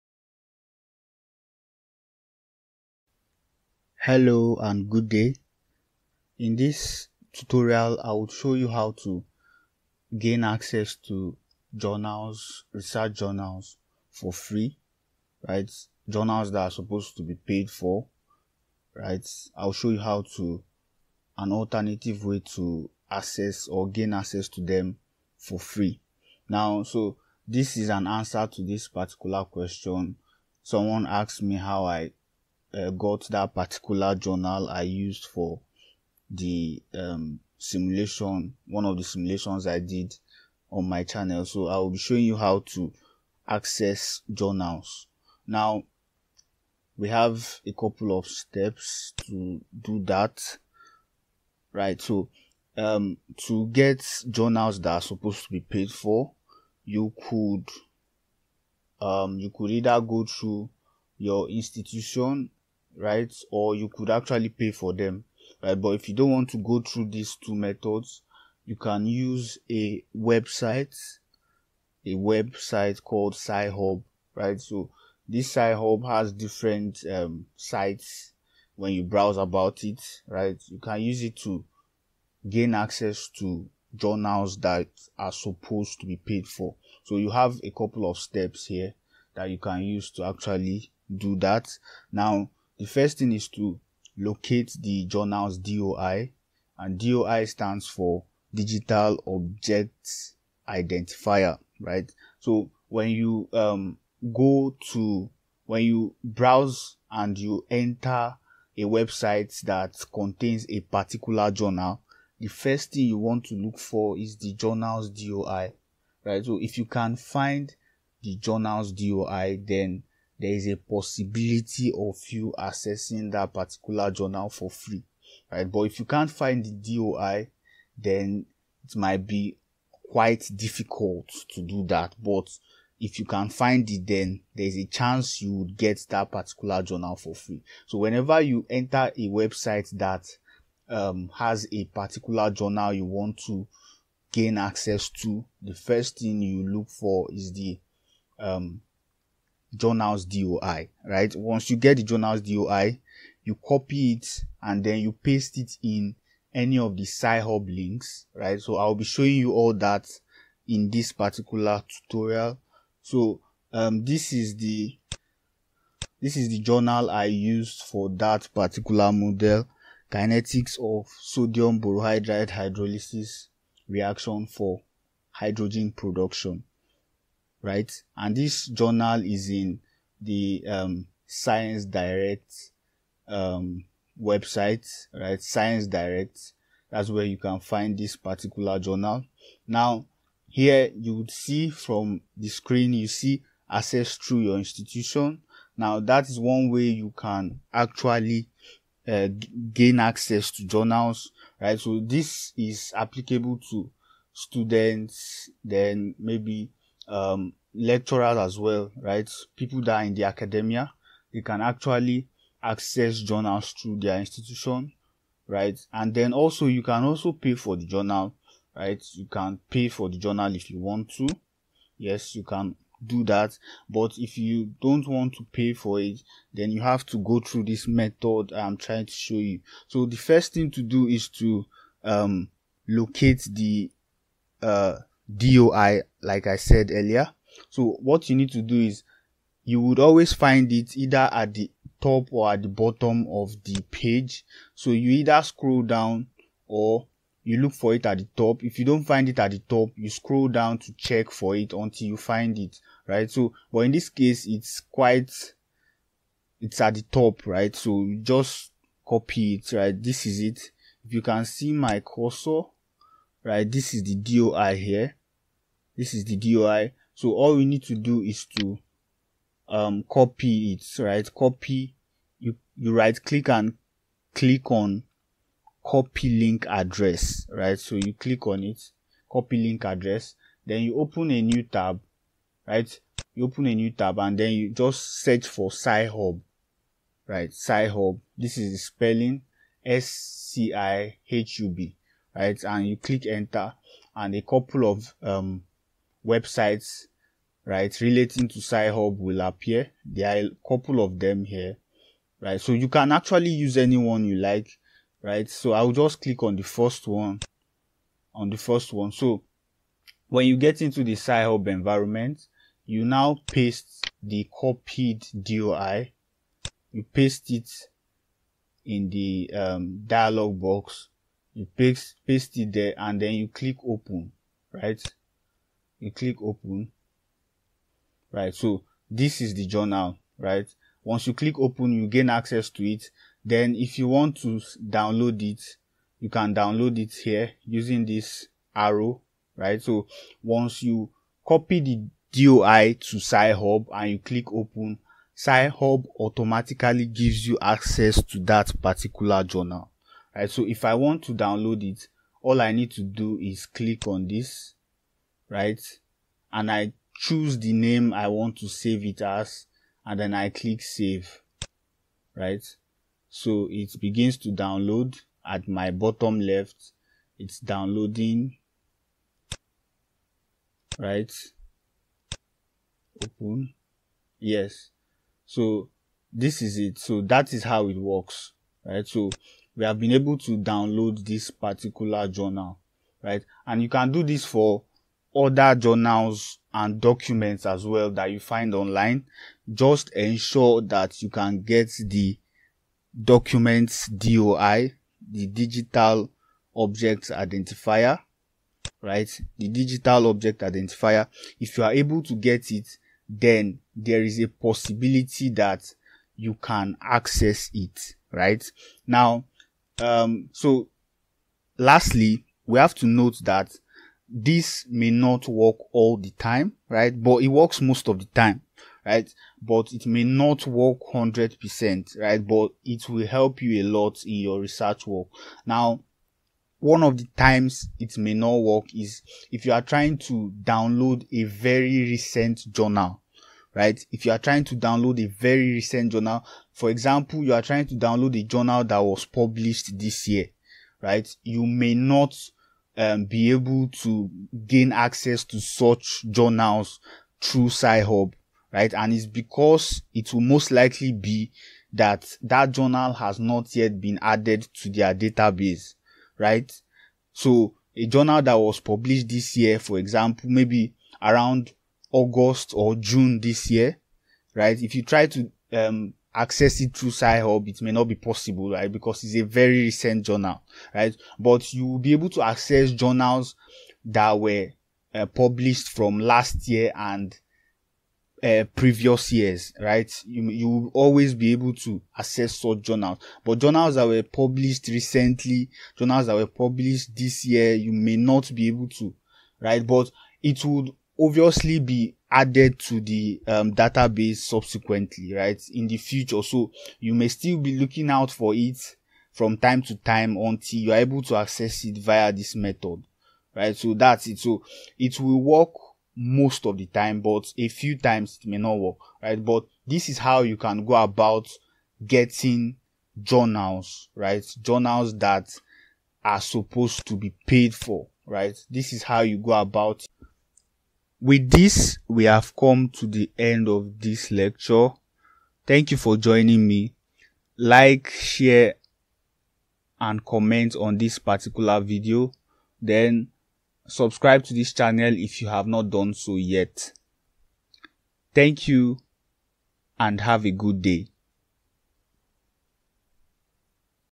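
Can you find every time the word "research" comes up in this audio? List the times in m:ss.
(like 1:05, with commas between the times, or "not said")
0:12, 7:04.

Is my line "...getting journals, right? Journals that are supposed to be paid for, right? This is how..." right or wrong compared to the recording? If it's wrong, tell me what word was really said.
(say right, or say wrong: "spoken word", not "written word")
right.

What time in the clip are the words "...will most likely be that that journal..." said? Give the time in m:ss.
7:30.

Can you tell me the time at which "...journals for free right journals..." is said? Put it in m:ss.
0:13.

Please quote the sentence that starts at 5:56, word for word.
And I choose the name I want to save it as, and then I click save, right?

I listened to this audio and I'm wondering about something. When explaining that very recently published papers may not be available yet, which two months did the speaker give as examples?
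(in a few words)
August or June.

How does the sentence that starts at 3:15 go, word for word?
Now, that is one way you can actually uh, gain access to journals, right?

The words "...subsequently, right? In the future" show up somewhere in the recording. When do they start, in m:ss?
8:14.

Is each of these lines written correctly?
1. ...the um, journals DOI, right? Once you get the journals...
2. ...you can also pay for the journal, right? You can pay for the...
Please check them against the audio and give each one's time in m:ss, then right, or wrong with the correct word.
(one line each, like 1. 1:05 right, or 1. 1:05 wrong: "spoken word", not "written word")
1. 2:27 right
2. 3:36 right.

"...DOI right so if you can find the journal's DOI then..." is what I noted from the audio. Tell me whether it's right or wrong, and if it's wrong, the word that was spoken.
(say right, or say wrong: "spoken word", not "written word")
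right.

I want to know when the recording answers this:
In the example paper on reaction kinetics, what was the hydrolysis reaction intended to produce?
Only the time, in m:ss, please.
2:55.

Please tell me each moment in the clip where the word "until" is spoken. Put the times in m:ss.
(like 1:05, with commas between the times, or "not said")
4:11, 8:20.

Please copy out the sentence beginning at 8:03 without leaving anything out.
But journals that were published recently, journals that were published this year, you may not be able to, right?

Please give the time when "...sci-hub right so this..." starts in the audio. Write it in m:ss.
1:13.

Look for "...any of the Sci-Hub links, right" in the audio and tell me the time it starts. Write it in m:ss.
2:36.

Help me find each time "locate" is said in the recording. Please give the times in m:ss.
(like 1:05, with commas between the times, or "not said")
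1:34, 3:52.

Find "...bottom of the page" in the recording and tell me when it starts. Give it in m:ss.
4:02.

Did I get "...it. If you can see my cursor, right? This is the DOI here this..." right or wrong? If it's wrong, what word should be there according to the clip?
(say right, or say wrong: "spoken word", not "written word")
right.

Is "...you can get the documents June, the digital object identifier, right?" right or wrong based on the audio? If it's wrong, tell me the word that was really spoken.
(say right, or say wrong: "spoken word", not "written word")
wrong: "DOI", not "June".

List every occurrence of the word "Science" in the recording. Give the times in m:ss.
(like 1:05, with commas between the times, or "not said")
3:01, 3:05.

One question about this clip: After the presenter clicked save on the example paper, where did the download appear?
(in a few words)
bottom left.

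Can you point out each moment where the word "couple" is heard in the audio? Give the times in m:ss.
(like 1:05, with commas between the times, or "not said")
0:47, 1:27, 4:54, 5:00.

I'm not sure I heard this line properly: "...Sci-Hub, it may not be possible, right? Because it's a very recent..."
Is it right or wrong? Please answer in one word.
right.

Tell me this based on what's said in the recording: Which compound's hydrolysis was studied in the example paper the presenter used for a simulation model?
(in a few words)
sodium borohydride.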